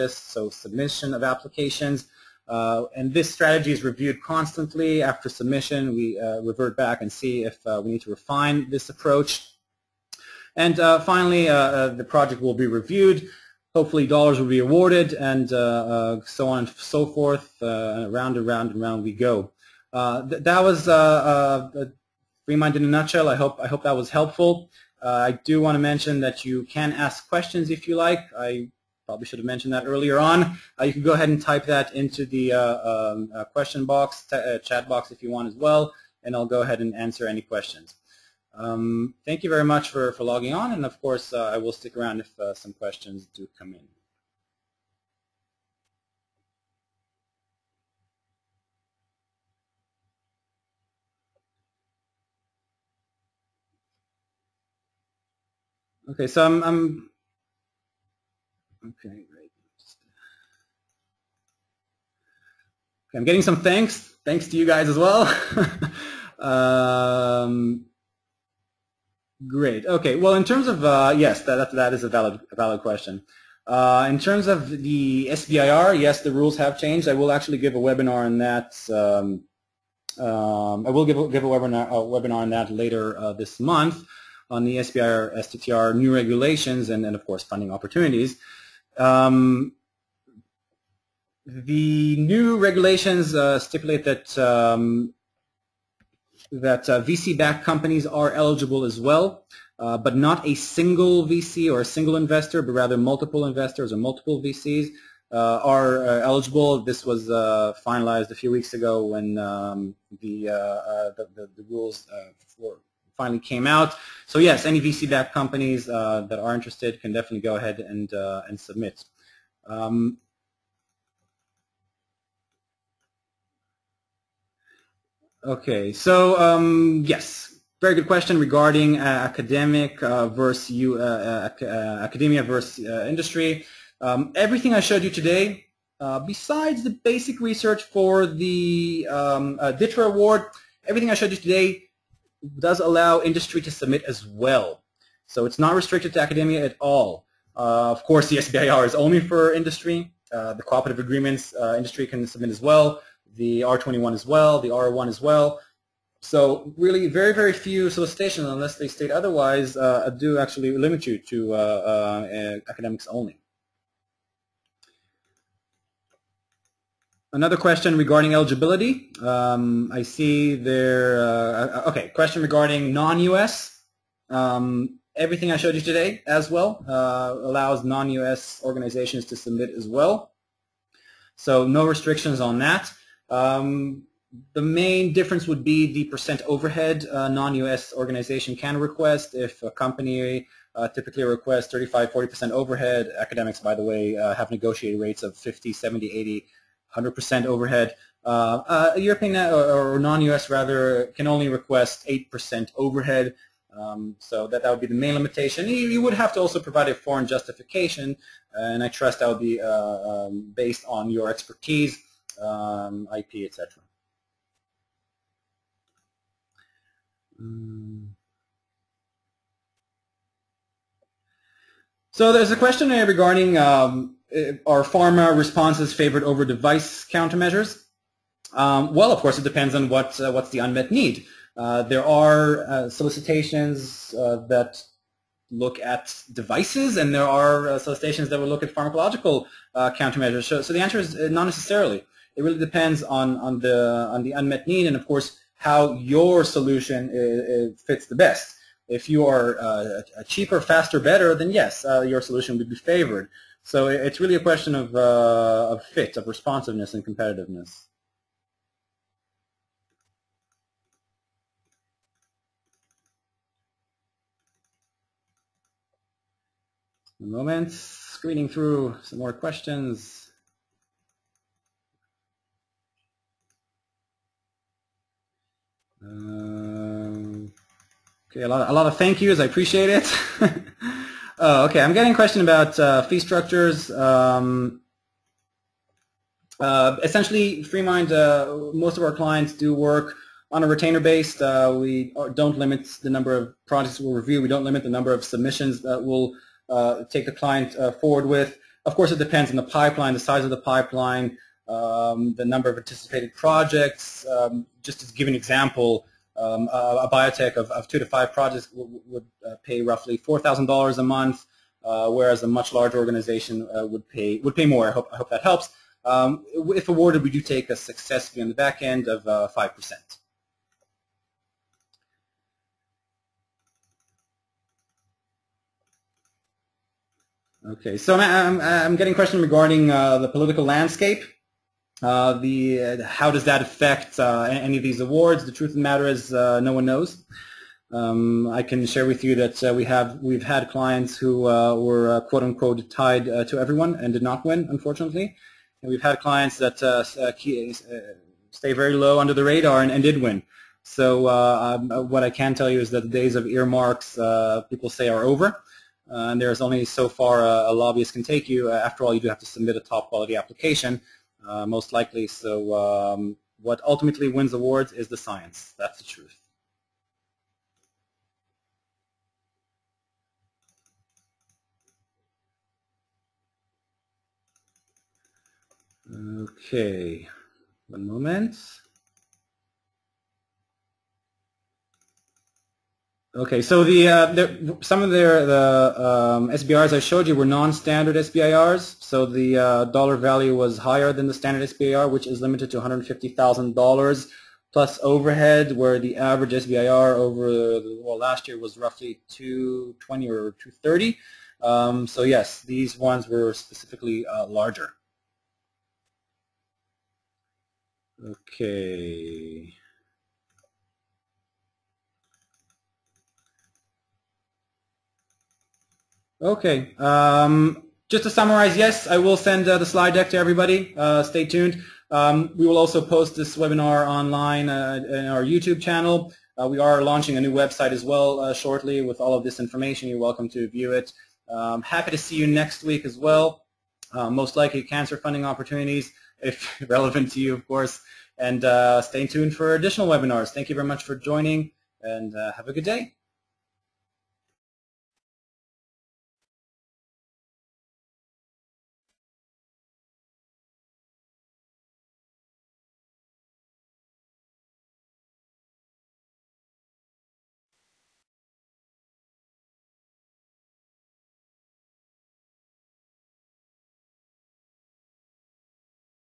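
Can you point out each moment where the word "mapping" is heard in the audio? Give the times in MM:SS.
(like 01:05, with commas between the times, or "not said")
not said.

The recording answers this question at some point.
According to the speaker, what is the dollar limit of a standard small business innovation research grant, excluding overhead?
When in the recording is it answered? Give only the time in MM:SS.
06:32.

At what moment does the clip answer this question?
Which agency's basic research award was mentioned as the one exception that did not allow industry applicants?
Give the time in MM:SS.
02:19.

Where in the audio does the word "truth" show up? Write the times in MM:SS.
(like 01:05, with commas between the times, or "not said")
05:35, 06:06.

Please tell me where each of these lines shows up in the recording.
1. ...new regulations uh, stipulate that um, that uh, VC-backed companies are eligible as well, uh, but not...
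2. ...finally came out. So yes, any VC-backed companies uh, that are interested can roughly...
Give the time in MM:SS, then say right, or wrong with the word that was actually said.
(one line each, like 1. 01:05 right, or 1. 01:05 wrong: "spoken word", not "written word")
1. 01:32 right
2. 01:53 wrong: "definitely", not "roughly".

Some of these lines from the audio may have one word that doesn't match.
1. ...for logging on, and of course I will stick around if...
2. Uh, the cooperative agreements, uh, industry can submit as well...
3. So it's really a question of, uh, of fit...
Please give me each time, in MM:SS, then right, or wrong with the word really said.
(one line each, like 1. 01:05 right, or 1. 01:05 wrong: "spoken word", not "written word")
1. 00:40 right
2. 02:30 right
3. 04:13 right.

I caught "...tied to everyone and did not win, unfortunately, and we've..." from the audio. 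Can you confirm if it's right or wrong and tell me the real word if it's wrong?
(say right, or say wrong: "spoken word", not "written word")
right.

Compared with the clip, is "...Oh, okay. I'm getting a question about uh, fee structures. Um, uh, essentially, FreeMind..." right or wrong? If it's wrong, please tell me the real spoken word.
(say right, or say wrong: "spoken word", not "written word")
right.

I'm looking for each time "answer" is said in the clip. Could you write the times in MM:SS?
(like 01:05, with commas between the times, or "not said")
00:36, 04:00.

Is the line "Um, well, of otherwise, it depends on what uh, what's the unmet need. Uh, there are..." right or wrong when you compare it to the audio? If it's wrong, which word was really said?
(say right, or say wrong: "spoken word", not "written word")
wrong: "course", not "otherwise".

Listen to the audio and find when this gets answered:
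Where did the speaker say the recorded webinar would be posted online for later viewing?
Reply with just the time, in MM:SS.
07:05.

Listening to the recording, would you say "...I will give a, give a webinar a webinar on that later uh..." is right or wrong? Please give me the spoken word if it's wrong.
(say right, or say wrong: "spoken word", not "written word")
right.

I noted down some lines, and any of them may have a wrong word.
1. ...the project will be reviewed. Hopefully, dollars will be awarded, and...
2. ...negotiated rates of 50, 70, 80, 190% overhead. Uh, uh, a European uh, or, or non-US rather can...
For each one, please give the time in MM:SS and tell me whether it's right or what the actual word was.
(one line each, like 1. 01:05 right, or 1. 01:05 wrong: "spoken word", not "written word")
1. 00:11 right
2. 03:14 wrong: "100", not "190".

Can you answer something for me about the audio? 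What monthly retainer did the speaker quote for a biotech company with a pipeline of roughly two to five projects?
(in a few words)
$4,000.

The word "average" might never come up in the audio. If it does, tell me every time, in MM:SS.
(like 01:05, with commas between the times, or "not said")
06:36.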